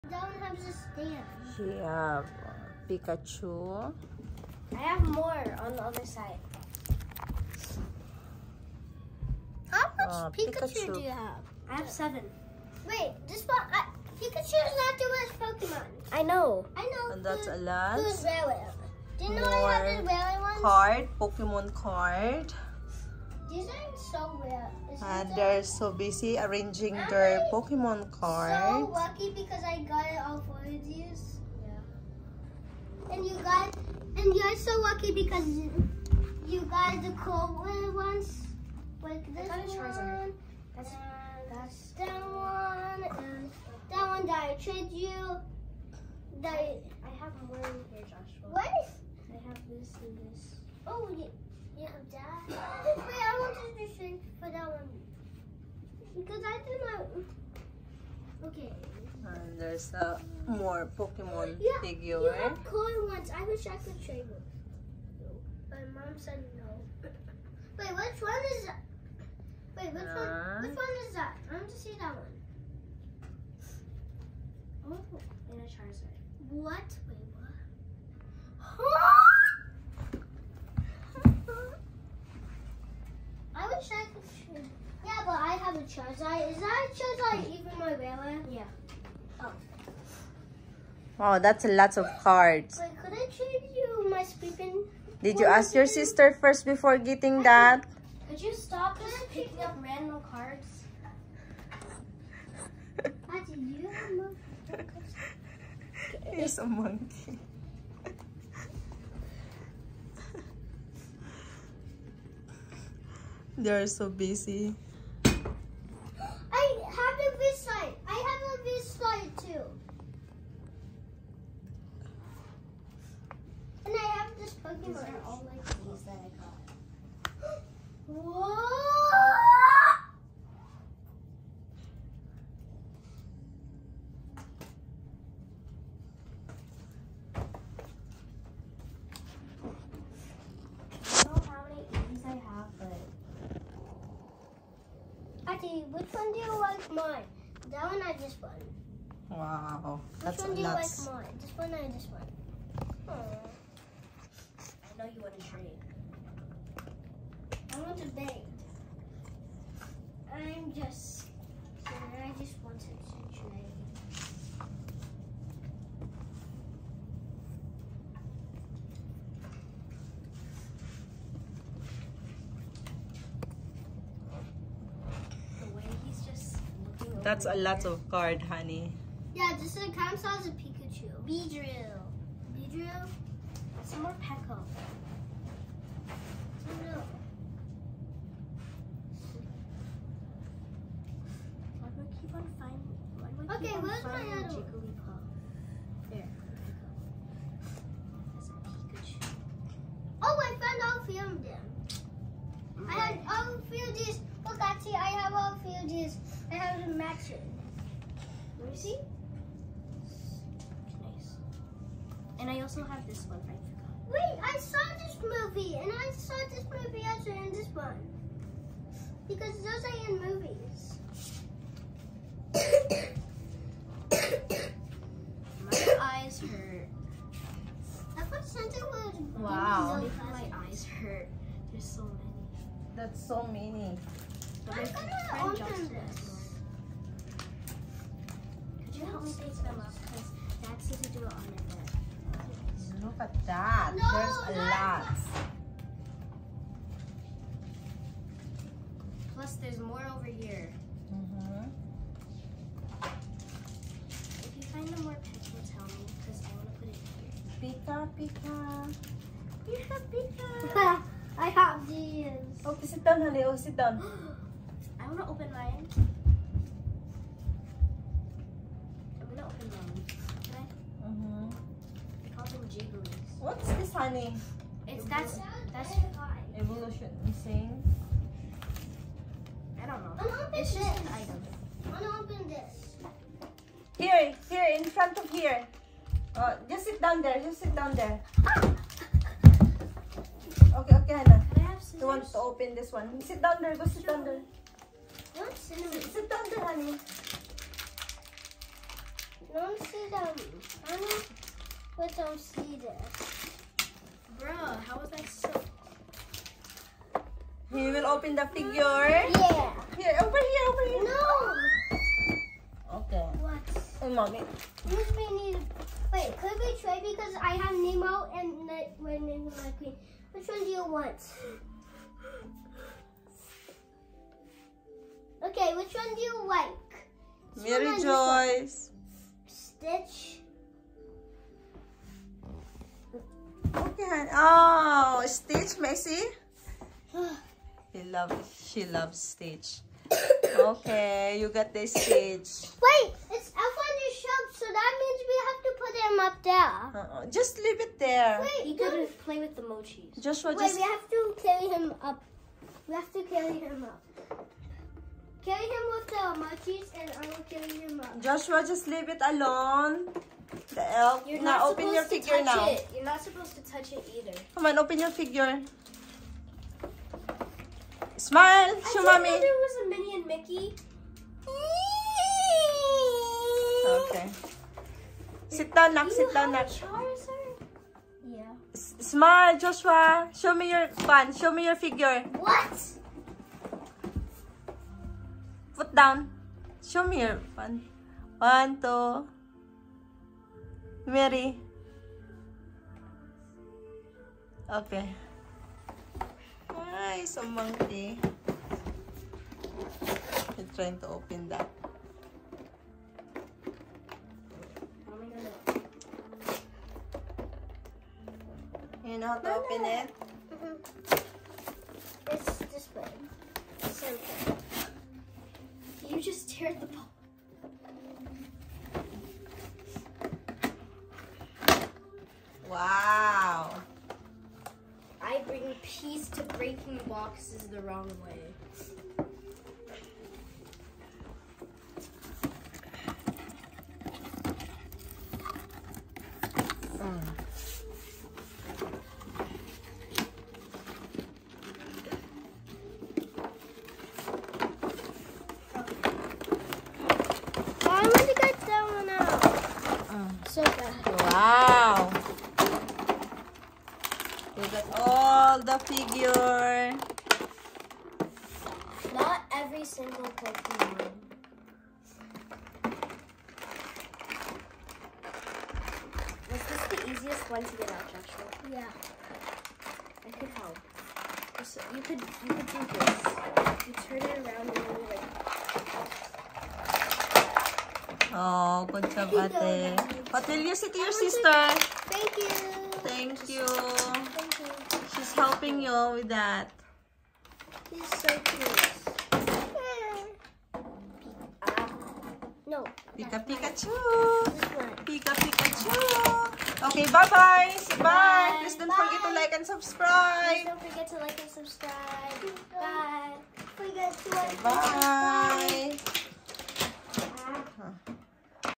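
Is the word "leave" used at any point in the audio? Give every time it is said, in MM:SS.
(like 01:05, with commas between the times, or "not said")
05:47, 05:58.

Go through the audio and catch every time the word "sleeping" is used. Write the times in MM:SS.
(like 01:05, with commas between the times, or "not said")
01:34.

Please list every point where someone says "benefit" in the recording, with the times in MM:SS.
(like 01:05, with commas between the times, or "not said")
not said.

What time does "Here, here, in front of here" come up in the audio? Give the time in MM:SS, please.
04:43.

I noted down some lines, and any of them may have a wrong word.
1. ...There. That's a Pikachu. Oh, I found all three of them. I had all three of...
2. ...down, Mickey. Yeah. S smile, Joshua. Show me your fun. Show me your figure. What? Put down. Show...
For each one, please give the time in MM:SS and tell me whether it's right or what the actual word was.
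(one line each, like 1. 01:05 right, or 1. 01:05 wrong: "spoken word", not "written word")
1. 03:16 right
2. 06:16 wrong: "Nak", not "Mickey".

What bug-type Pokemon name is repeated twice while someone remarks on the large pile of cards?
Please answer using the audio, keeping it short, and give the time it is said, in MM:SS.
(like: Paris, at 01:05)
Beedrill, at 03:01.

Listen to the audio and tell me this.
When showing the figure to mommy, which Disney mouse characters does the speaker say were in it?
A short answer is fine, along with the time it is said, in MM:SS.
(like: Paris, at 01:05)
Minnie and Mickey, at 06:09.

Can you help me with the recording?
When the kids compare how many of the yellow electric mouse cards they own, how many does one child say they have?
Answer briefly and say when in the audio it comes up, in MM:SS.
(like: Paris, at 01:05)
7, at 00:11.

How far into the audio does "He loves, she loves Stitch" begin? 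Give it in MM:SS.
05:37.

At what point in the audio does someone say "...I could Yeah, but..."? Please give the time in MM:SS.
01:23.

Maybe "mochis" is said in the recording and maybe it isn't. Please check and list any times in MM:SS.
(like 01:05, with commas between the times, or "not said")
05:49, 05:56.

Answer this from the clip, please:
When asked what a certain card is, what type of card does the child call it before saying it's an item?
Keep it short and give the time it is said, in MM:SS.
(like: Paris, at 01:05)
evolution, at 04:35.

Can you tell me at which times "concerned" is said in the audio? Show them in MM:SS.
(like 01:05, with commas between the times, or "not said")
not said.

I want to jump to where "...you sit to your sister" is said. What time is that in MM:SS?
08:00.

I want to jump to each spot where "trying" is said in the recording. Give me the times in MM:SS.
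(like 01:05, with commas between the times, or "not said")
06:40.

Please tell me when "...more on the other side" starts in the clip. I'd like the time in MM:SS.
00:05.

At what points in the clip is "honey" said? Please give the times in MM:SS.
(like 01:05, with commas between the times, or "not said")
02:58, 04:23, 04:33, 04:56, 05:00, 05:34.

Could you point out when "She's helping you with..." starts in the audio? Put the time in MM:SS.
08:05.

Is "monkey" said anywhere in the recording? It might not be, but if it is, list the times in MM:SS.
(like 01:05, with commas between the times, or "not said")
01:46, 06:37.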